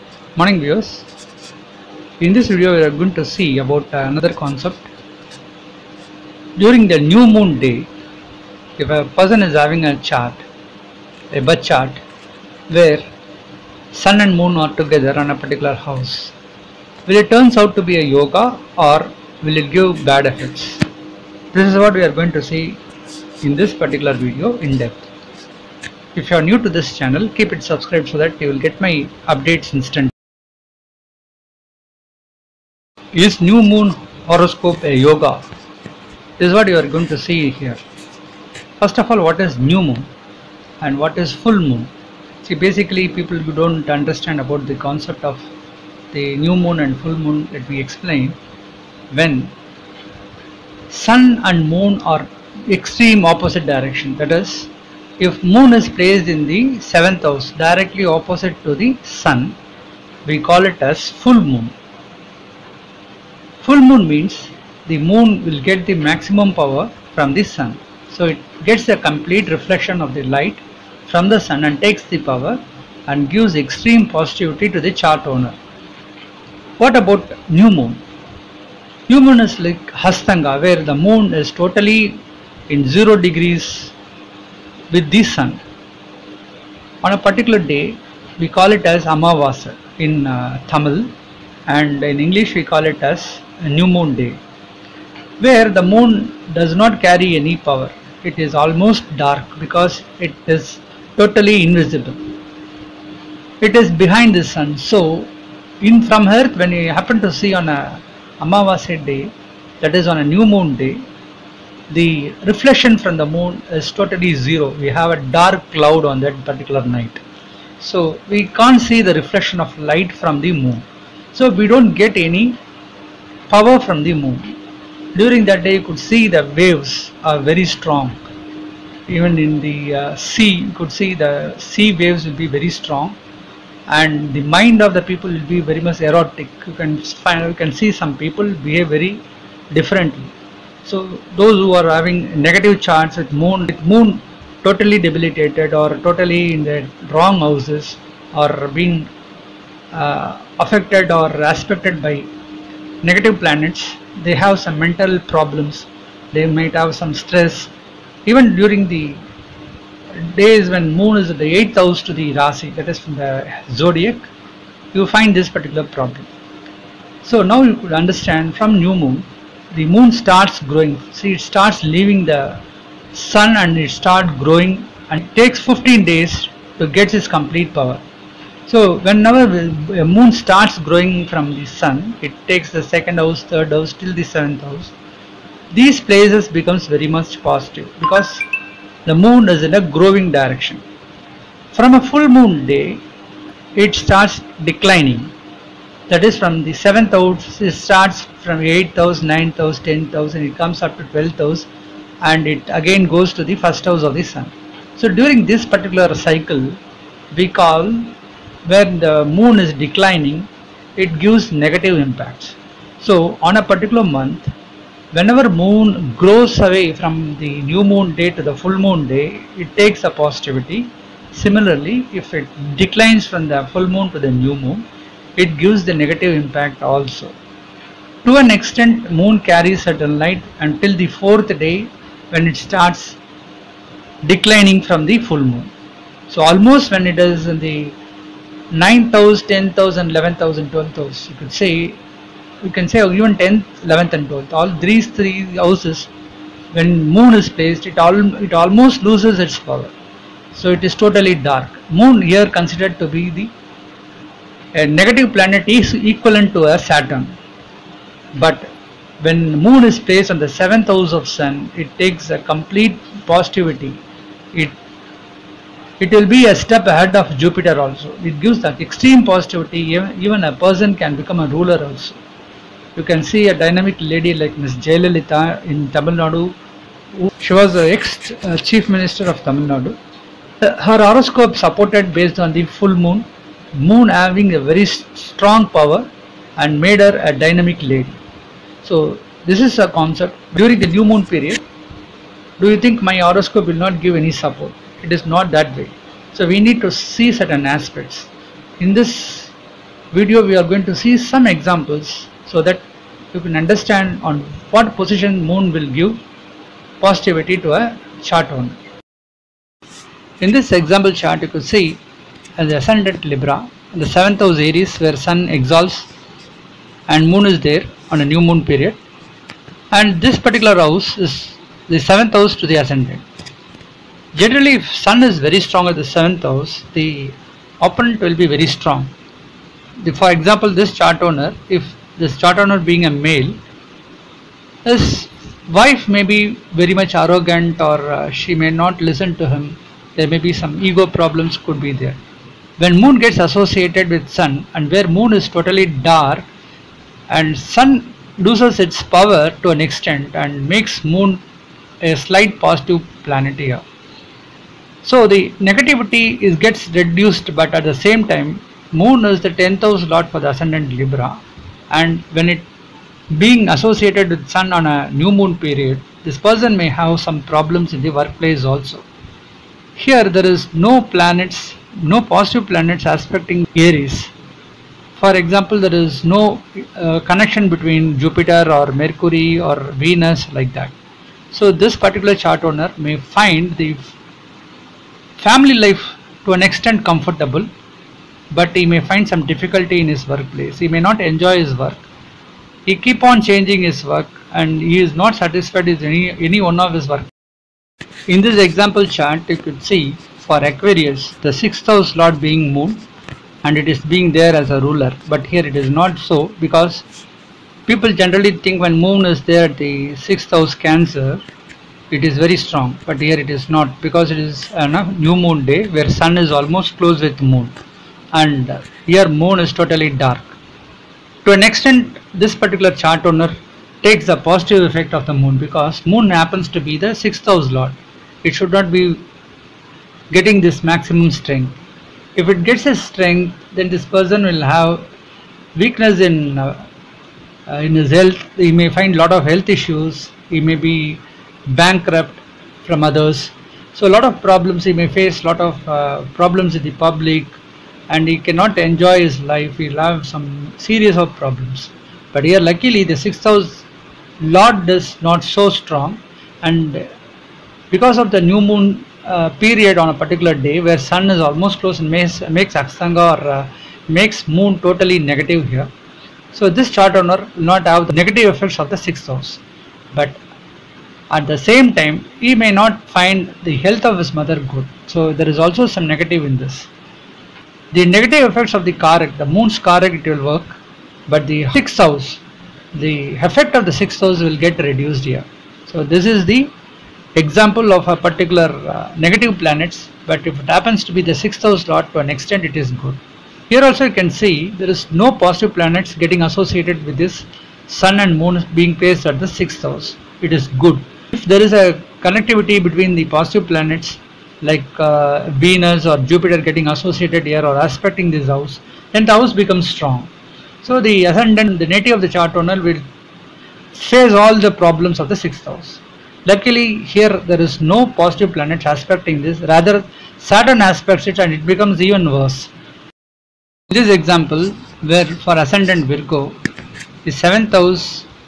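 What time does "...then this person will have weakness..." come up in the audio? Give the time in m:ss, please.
7:13.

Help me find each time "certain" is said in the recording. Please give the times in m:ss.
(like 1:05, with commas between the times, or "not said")
3:49, 4:57.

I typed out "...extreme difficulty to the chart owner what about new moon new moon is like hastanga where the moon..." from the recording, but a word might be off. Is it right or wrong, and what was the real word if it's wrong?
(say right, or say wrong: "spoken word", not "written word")
wrong: "positivity", not "difficulty".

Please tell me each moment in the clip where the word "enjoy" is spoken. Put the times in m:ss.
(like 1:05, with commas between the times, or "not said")
6:31, 7:28.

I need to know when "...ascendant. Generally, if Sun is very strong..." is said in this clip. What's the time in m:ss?
5:22.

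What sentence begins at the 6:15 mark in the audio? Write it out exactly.
For example, there is no uh, connection between Jupiter or Mercury or Venus like that.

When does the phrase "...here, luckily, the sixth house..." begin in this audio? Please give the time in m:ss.
7:32.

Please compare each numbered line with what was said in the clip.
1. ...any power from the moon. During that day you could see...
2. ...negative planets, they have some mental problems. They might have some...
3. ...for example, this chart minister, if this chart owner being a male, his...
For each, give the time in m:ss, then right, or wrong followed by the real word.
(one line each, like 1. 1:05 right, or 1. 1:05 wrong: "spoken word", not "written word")
1. 2:02 right
2. 2:33 right
3. 5:30 wrong: "owner", not "minister".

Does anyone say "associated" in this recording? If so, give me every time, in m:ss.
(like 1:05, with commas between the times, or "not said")
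5:43, 6:03, 8:16, 8:26.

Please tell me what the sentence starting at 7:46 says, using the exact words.
So this chart owner will not have the negative effects of the sixth house.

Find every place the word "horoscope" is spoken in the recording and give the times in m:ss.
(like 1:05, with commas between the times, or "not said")
0:34, 4:41, 4:53.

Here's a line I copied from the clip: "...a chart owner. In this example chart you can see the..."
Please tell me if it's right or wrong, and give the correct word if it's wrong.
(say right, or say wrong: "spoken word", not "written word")
right.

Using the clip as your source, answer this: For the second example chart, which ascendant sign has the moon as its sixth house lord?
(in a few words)
Aquarius.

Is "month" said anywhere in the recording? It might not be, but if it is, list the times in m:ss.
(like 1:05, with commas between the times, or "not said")
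3:34.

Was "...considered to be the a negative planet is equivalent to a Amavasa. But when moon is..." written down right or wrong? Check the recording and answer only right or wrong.
wrong.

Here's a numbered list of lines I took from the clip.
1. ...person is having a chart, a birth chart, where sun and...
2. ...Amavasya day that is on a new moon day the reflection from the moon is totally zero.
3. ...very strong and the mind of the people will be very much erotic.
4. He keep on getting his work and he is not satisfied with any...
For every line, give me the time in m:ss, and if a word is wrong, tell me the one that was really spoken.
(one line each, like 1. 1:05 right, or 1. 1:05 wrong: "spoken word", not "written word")
1. 0:09 right
2. 1:48 right
3. 2:12 right
4. 6:32 wrong: "changing", not "getting".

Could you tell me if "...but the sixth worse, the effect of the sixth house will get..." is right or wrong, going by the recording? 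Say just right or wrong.
wrong.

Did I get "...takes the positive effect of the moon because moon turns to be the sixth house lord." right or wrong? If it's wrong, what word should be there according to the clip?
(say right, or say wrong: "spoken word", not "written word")
wrong: "happens", not "turns".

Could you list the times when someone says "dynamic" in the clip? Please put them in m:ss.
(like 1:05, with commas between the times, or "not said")
4:33, 4:47.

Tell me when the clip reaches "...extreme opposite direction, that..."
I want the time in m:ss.
0:52.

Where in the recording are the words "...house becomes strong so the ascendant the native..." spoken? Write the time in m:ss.
8:29.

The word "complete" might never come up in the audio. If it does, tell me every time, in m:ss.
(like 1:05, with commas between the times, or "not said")
1:08, 2:57, 4:22.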